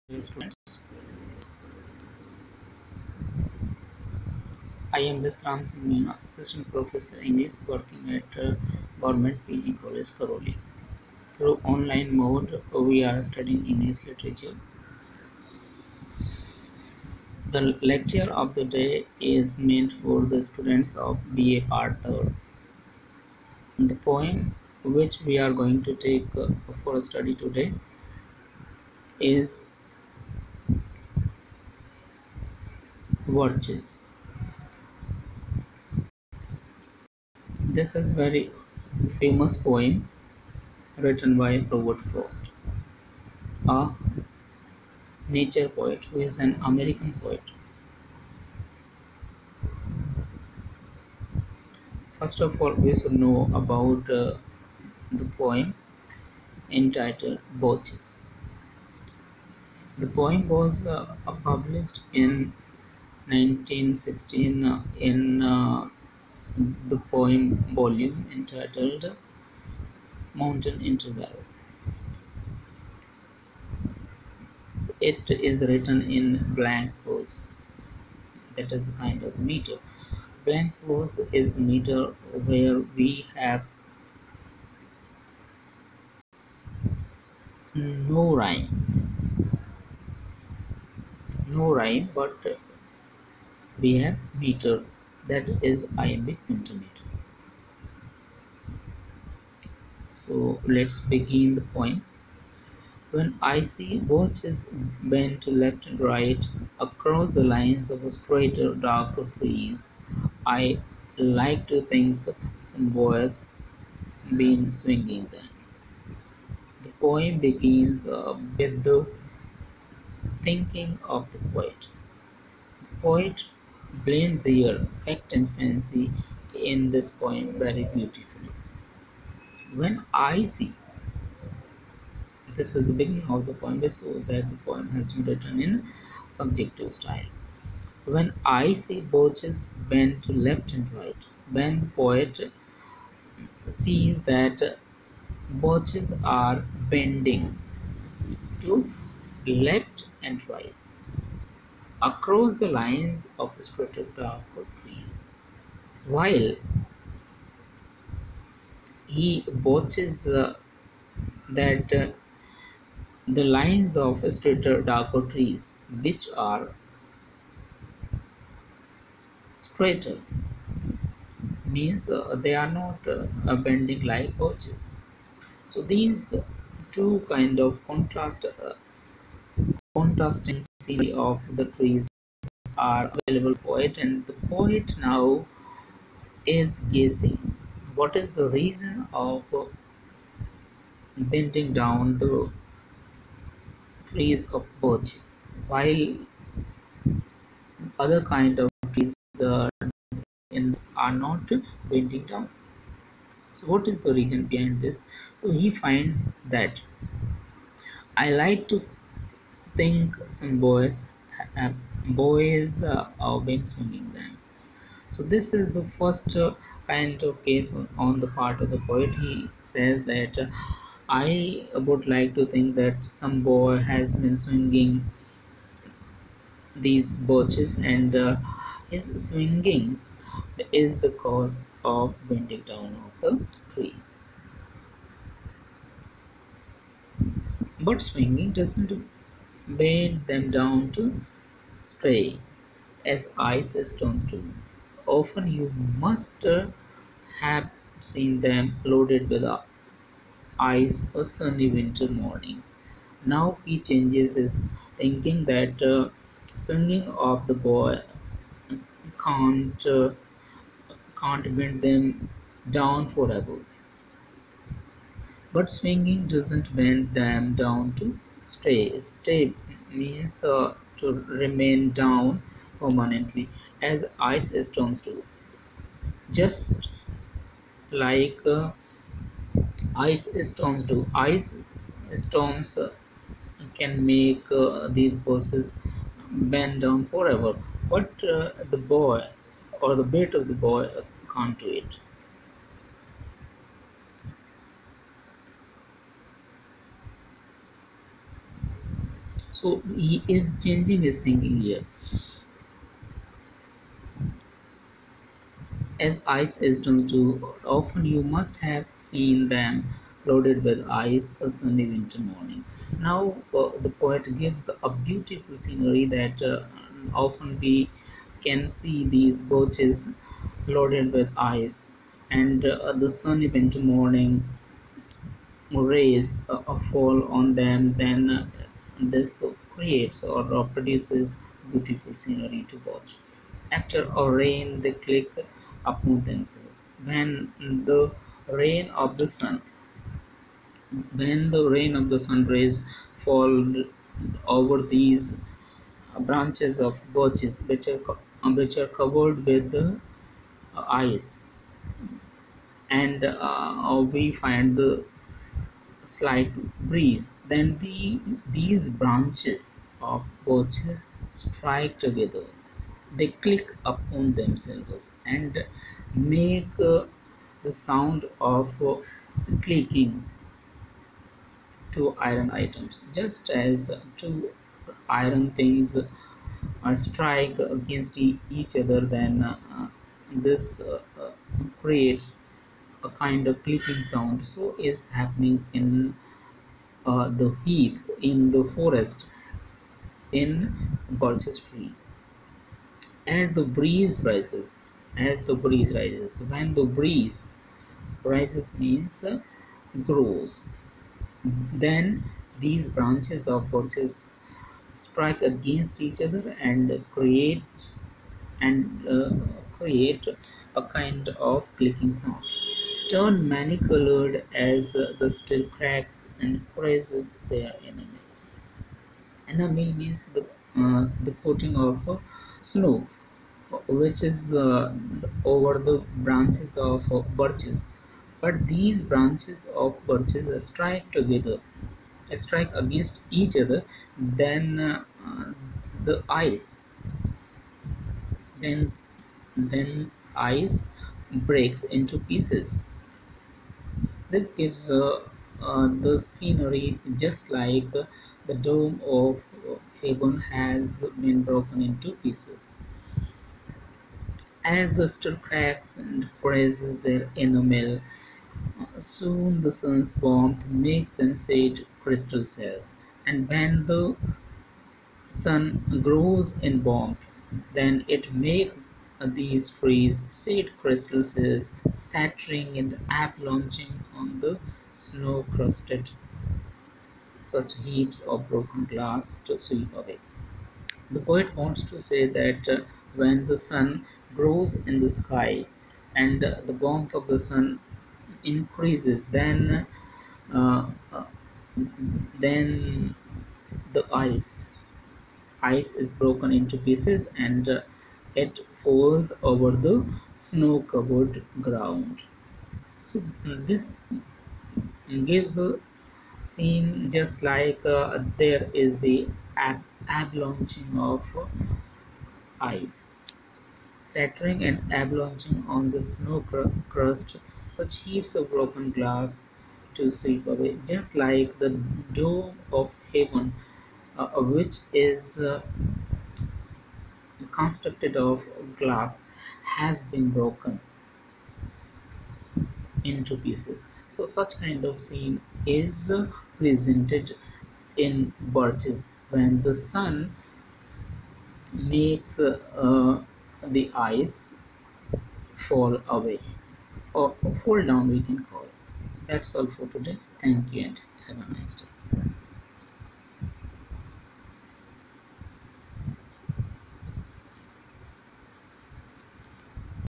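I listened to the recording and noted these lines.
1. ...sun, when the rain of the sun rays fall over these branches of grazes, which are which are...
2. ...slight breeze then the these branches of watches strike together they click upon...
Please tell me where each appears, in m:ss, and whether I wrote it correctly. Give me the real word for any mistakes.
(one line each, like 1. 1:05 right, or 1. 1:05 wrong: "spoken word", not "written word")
1. 5:39 wrong: "birches", not "grazes"
2. 5:56 wrong: "birches", not "watches".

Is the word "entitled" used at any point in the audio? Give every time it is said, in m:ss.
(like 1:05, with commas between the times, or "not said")
0:56, 1:08.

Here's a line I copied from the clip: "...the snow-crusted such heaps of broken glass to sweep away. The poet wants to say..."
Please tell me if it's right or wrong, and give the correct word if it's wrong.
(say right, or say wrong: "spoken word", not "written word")
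right.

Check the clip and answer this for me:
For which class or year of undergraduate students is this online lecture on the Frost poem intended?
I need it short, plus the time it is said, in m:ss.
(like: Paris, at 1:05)
BA Part 3, at 0:21.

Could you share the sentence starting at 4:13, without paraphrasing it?
Now he changes his thinking that uh, swinging of the boy can't uh, can't bend them down forever.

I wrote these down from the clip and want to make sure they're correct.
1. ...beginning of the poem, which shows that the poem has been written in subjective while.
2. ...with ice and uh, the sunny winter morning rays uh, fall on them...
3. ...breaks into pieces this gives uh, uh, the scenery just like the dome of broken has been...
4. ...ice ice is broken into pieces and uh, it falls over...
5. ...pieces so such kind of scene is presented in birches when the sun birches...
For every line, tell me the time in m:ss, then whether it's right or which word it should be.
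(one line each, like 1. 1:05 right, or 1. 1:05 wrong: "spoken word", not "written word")
1. 2:12 wrong: "style", not "while"
2. 5:21 right
3. 7:21 wrong: "heaven", not "broken"
4. 8:14 right
5. 8:53 wrong: "makes", not "birches".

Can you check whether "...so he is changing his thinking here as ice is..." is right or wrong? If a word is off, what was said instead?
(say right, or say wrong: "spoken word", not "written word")
right.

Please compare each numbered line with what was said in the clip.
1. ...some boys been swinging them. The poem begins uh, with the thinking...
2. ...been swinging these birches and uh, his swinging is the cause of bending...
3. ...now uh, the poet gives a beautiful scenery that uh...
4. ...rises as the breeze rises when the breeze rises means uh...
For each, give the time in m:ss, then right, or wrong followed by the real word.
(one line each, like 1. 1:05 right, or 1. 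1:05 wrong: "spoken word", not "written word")
1. 1:52 right
2. 3:44 right
3. 5:13 right
4. 6:34 right.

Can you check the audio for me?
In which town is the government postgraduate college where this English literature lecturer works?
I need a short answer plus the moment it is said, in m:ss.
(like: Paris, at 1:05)
Karauli, at 0:10.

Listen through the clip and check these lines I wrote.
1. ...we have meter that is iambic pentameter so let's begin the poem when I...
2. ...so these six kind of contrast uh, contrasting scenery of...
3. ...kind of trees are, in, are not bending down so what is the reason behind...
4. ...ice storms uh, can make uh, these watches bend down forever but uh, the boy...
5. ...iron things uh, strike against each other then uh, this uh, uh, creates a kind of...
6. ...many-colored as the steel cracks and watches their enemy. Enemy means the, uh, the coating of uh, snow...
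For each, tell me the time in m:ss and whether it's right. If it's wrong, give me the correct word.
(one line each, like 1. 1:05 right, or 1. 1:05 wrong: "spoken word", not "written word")
1. 1:33 right
2. 2:55 wrong: "two", not "six"
3. 3:18 right
4. 4:41 wrong: "buses", not "watches"
5. 6:15 right
6. 6:53 wrong: "grazes", not "watches".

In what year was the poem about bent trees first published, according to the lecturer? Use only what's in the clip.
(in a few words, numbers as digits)
1916.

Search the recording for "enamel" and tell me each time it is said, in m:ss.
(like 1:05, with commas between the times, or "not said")
7:37.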